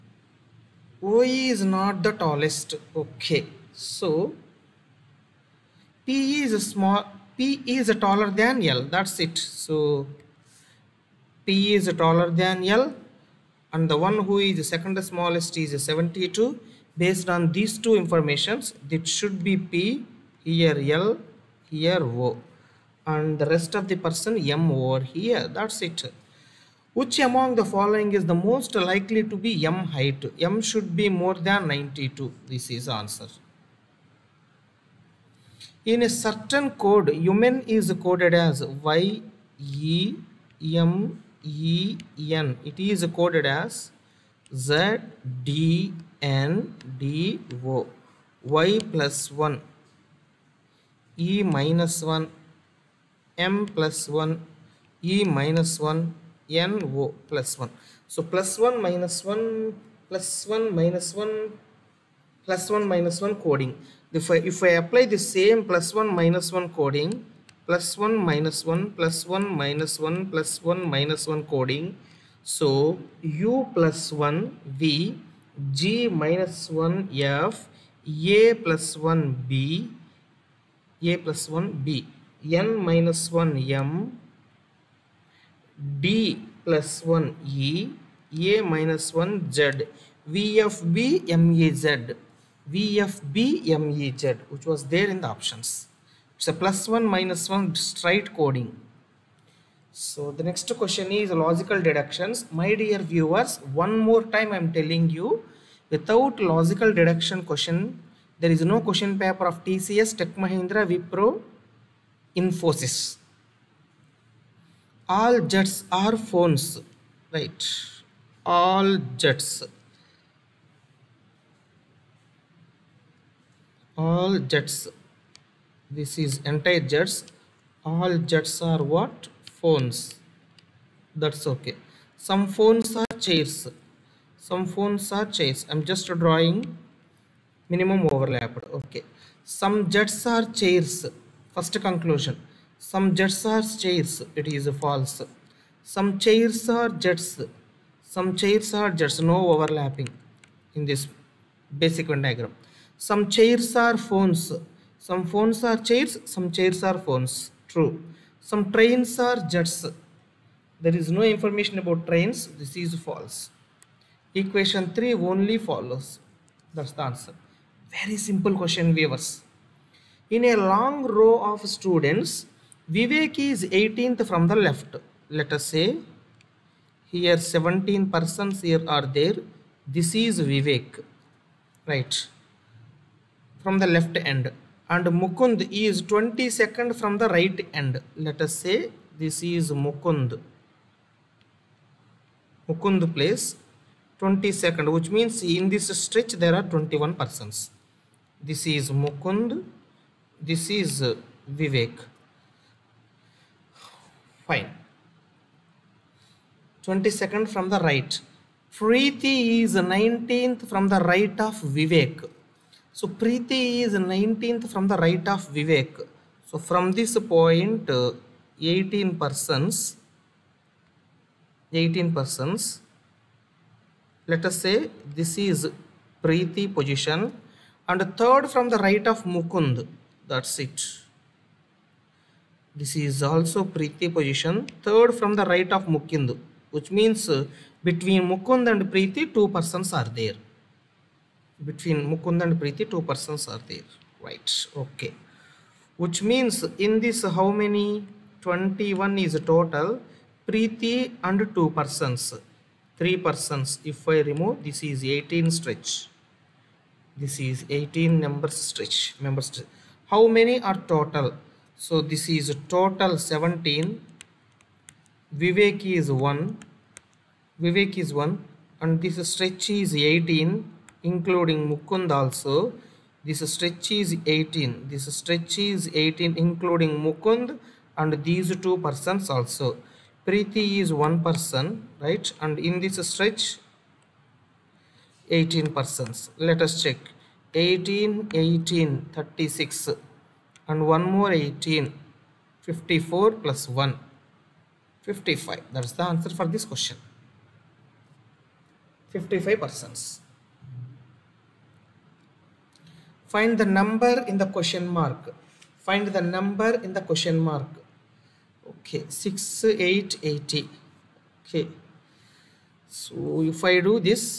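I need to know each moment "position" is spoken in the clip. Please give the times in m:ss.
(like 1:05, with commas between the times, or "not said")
3:46, 3:54.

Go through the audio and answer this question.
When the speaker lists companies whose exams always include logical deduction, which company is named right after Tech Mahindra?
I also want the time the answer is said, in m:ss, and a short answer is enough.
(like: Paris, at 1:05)
Wipro, at 1:50.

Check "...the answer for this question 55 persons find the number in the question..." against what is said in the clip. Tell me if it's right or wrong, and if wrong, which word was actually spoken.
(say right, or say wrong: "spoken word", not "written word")
right.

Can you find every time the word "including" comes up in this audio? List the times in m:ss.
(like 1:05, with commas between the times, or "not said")
4:31, 4:36.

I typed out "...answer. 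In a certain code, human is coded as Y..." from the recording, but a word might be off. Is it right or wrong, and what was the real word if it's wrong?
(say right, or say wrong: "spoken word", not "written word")
right.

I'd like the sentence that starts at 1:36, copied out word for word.
It's a plus 1 minus 1 straight coding.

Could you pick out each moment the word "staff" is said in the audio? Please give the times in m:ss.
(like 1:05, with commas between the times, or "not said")
not said.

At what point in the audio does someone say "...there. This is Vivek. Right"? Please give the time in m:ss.
2:59.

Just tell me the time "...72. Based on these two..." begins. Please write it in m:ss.
0:15.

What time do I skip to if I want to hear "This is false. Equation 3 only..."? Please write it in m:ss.
2:42.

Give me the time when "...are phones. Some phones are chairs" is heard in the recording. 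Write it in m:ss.
2:33.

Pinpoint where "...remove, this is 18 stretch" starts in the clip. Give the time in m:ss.
4:14.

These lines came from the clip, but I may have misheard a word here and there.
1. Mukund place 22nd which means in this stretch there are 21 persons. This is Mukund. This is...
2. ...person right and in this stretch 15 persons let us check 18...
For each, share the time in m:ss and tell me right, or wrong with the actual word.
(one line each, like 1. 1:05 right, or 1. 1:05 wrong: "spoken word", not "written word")
1. 3:12 right
2. 4:41 wrong: "18", not "15".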